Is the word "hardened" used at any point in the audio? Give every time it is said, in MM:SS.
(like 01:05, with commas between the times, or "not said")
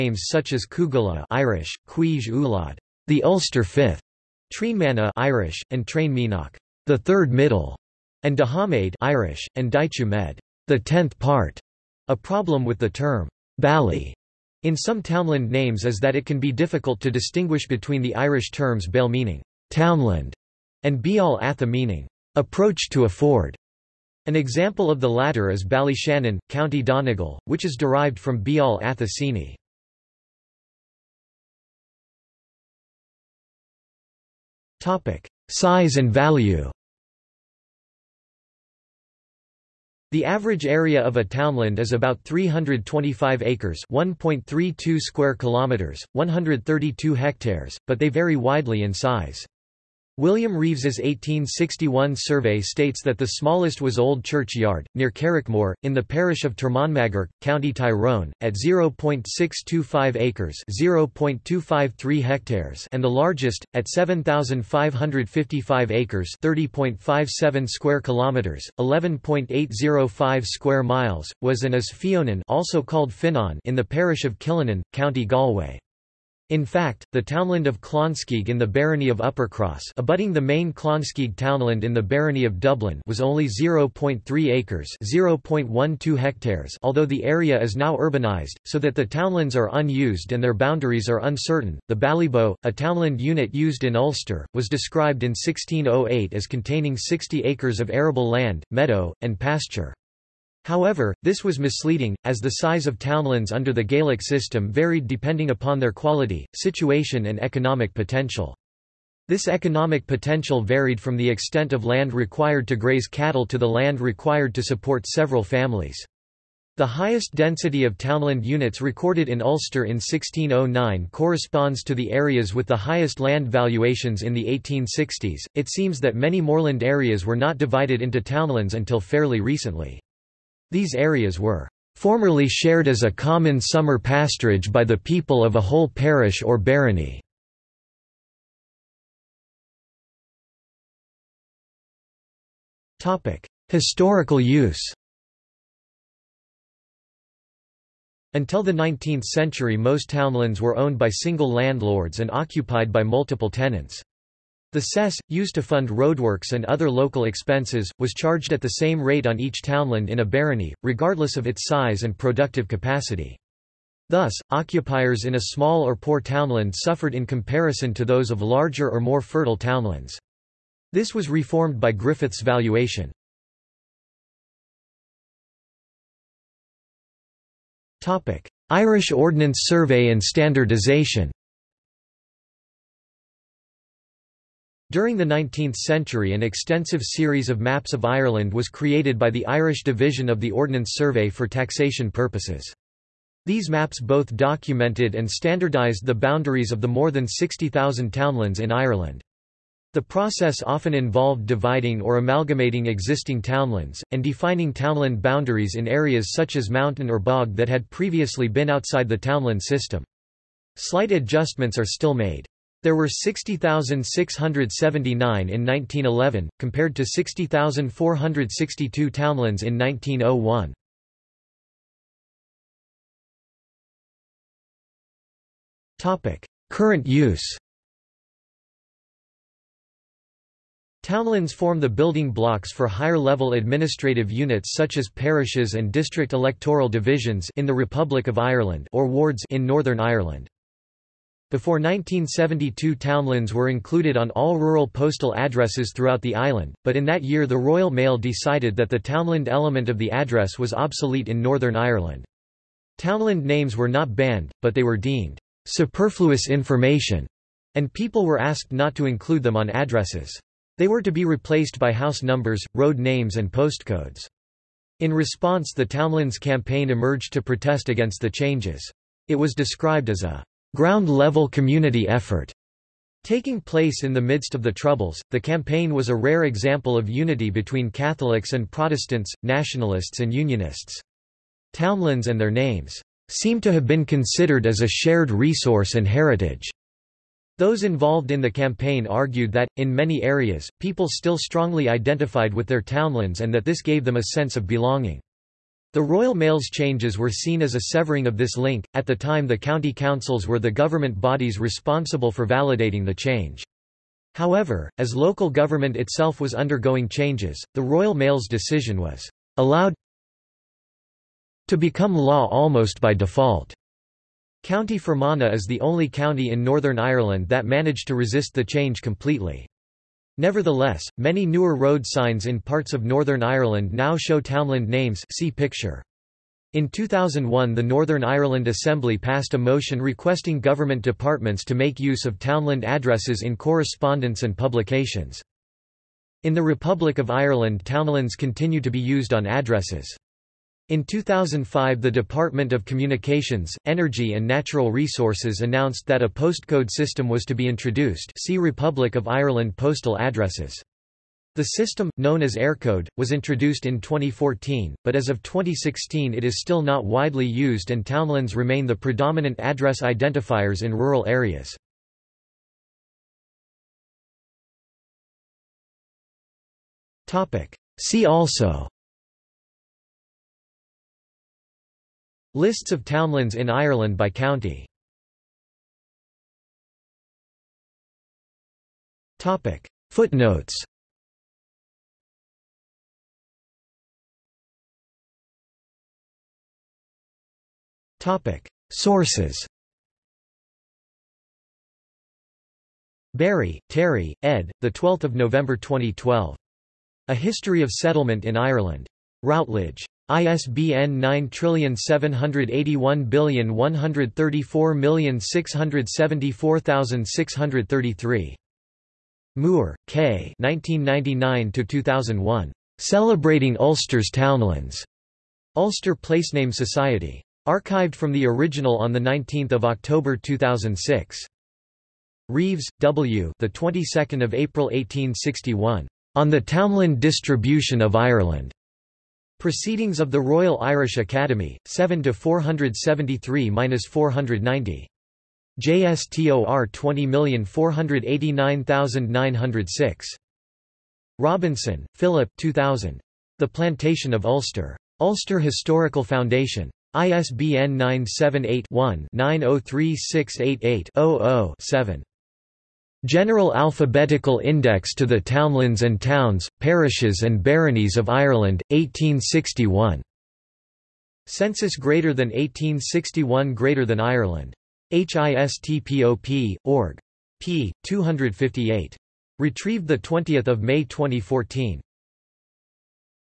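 not said.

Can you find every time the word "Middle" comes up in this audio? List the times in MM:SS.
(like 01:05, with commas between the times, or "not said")
00:07.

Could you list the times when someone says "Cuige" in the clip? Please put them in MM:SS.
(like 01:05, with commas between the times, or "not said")
00:01.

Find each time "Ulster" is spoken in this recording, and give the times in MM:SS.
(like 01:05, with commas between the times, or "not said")
00:03.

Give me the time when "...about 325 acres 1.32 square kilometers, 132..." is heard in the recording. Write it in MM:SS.
00:41.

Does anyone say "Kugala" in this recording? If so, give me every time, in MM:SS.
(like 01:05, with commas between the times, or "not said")
00:00.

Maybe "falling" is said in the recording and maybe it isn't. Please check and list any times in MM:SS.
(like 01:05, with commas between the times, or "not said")
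not said.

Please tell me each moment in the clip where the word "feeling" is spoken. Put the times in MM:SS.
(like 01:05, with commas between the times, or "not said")
not said.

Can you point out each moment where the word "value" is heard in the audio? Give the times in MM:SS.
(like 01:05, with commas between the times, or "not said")
00:36.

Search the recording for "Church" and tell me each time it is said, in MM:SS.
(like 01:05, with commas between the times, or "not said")
00:54.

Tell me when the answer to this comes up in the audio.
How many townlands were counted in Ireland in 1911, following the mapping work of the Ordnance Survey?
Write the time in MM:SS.
03:33.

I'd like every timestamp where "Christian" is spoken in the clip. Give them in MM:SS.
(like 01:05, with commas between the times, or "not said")
not said.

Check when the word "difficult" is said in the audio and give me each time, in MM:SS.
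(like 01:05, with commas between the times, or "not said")
00:16.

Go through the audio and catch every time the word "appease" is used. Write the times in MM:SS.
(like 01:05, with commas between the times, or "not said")
not said.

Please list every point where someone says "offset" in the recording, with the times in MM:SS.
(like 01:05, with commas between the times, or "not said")
not said.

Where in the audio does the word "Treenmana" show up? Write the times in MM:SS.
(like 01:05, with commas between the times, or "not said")
00:04.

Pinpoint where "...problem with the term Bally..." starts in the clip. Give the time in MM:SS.
00:12.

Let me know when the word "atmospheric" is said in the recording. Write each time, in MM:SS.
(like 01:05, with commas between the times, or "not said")
not said.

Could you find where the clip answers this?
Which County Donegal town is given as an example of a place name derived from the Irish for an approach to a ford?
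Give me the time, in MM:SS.
00:25.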